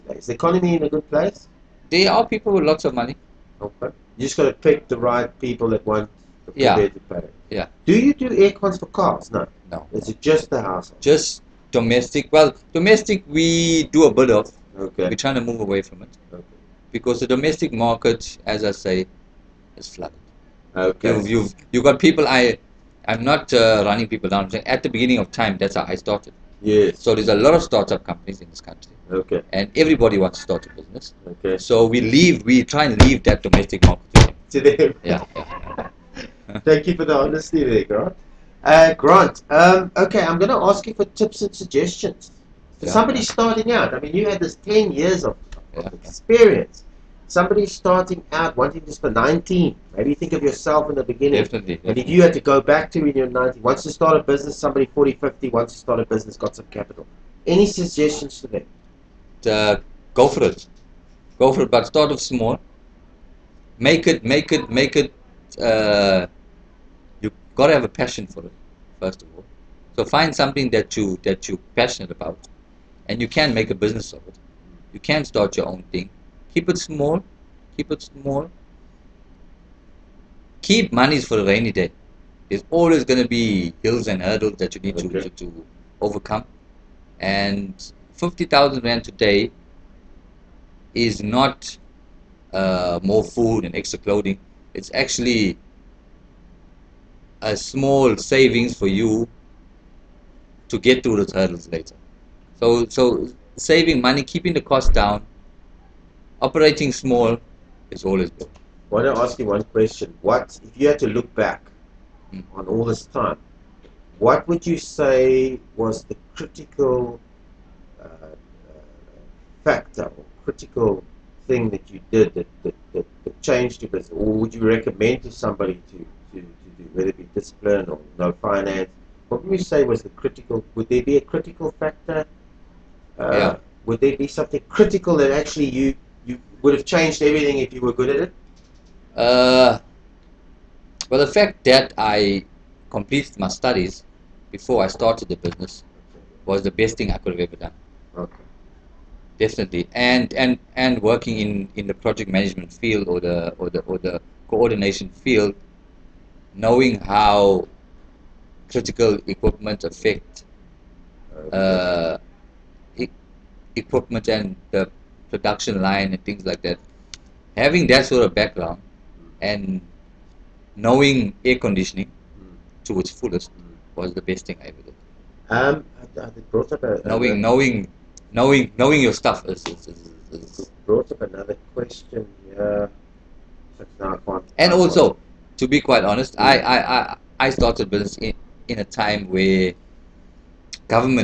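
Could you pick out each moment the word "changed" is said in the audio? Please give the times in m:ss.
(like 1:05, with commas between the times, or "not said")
2:03, 2:16.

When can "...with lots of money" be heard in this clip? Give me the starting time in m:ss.
0:02.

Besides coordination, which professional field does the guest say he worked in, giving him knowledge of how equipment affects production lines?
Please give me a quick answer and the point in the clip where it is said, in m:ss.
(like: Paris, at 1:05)
Project management, at 2:31.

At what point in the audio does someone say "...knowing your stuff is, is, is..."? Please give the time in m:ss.
2:58.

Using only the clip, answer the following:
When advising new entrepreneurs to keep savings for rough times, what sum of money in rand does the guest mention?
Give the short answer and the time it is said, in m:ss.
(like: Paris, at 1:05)
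50,000 rand, at 1:28.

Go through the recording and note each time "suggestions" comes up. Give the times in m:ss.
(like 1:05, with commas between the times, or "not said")
0:41, 0:57.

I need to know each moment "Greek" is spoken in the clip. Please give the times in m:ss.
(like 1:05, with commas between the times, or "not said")
not said.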